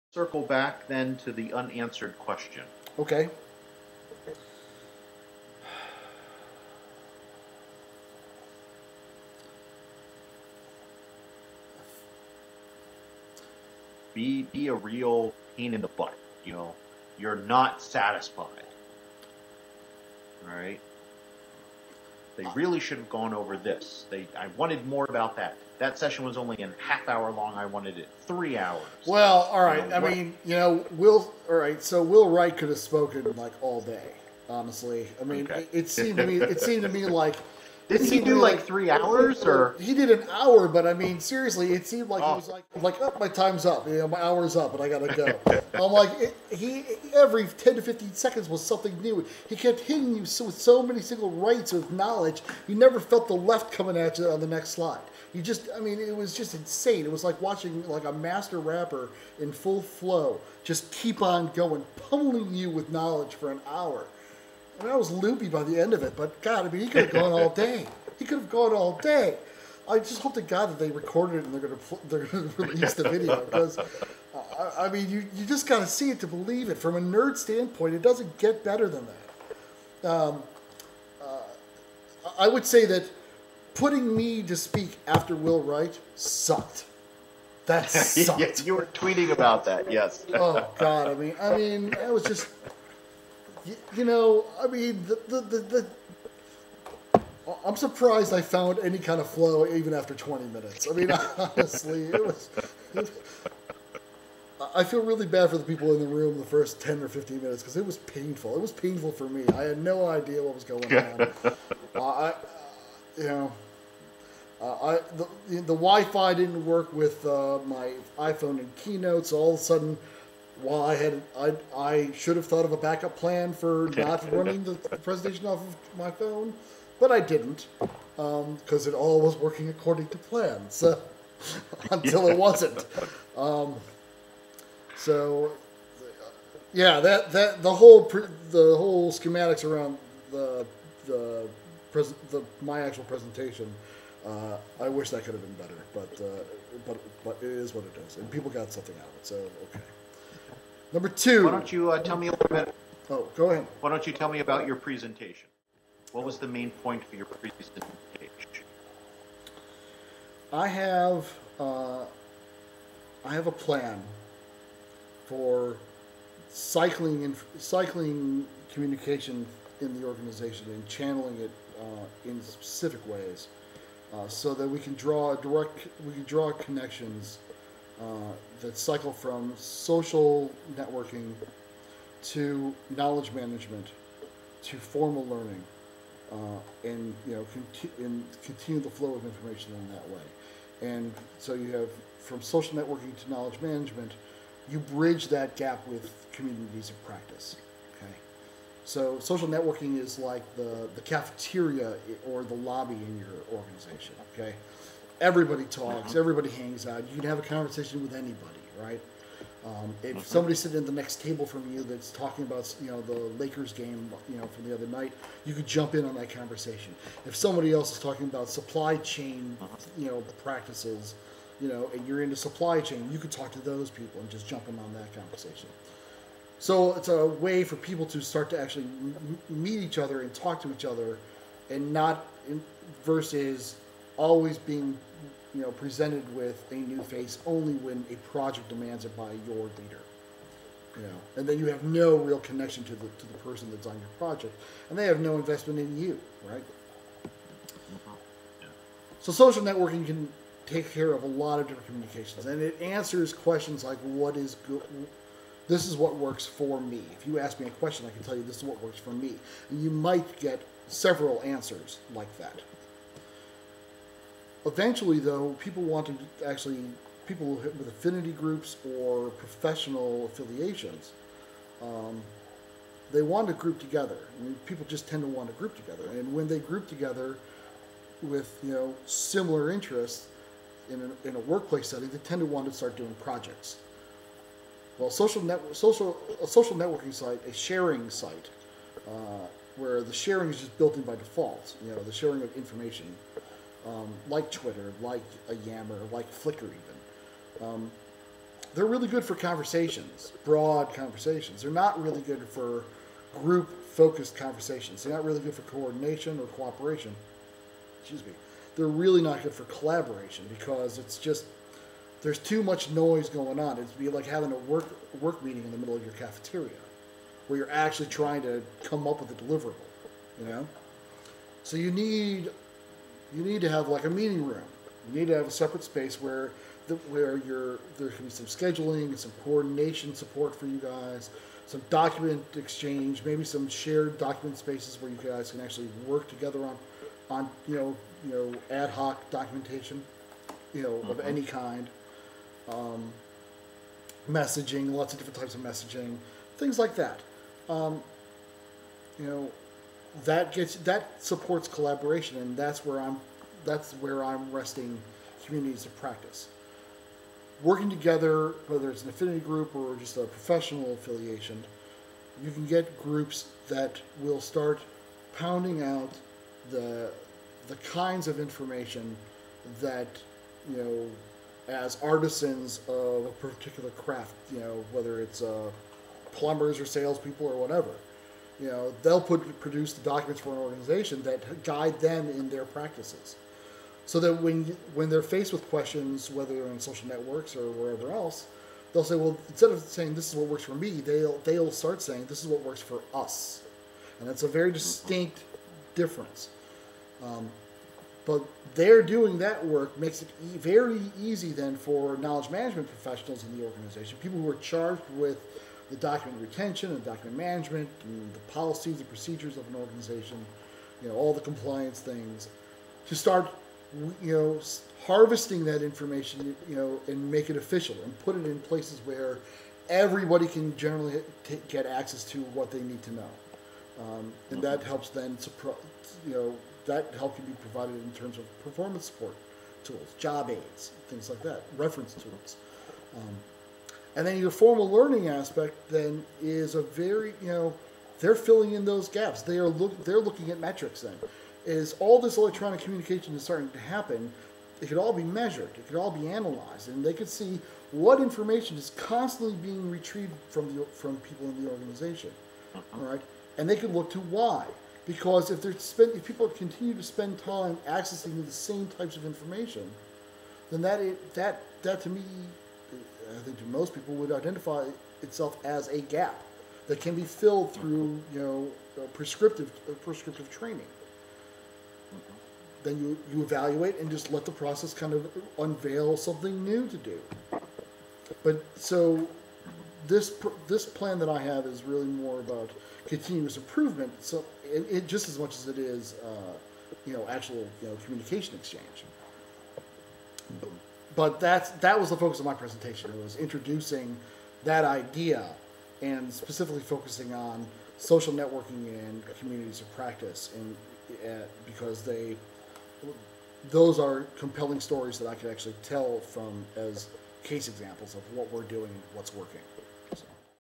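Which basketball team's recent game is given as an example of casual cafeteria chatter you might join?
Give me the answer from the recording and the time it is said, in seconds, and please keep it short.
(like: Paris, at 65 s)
Lakers, at 213 s.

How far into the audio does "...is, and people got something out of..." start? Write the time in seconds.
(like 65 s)
148 s.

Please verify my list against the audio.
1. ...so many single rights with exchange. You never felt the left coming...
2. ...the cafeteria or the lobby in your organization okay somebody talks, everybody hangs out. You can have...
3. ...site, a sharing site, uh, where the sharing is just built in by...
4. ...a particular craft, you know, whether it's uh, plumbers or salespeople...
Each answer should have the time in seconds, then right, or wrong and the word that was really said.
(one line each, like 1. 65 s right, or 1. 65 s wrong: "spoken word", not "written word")
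1. 50 s wrong: "knowledge", not "exchange"
2. 200 s wrong: "everybody", not "somebody"
3. 287 s right
4. 373 s right.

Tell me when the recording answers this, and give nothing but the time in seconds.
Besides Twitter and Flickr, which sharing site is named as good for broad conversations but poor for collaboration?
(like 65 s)
295 s.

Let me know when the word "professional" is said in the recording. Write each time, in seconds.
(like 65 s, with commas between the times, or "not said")
269 s, 360 s, 402 s.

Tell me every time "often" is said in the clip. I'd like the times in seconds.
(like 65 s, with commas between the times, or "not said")
not said.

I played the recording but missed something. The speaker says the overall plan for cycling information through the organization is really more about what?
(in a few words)
continuous improvement.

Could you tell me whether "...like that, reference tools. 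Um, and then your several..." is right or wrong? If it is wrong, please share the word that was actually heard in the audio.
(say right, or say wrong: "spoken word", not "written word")
wrong: "formal", not "several".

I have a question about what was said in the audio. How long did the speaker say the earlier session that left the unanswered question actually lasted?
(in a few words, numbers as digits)
half hour.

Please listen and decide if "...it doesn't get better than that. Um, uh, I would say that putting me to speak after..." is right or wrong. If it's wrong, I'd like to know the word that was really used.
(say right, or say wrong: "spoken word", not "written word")
right.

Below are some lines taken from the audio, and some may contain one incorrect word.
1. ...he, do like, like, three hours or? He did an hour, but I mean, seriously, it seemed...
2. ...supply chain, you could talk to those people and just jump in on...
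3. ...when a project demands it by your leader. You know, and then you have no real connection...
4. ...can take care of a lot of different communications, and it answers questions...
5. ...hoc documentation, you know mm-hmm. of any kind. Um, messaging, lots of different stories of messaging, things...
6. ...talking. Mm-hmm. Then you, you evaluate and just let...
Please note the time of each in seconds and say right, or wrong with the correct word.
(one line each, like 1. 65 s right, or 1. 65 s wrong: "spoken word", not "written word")
1. 38 s right
2. 222 s right
3. 237 s right
4. 250 s right
5. 338 s wrong: "types", not "stories"
6. 470 s wrong: "training", not "talking".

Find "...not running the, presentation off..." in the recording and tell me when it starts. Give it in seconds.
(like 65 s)
123 s.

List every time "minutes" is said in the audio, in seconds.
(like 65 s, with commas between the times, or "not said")
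100 s, 107 s.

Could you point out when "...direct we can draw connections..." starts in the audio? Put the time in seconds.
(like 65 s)
175 s.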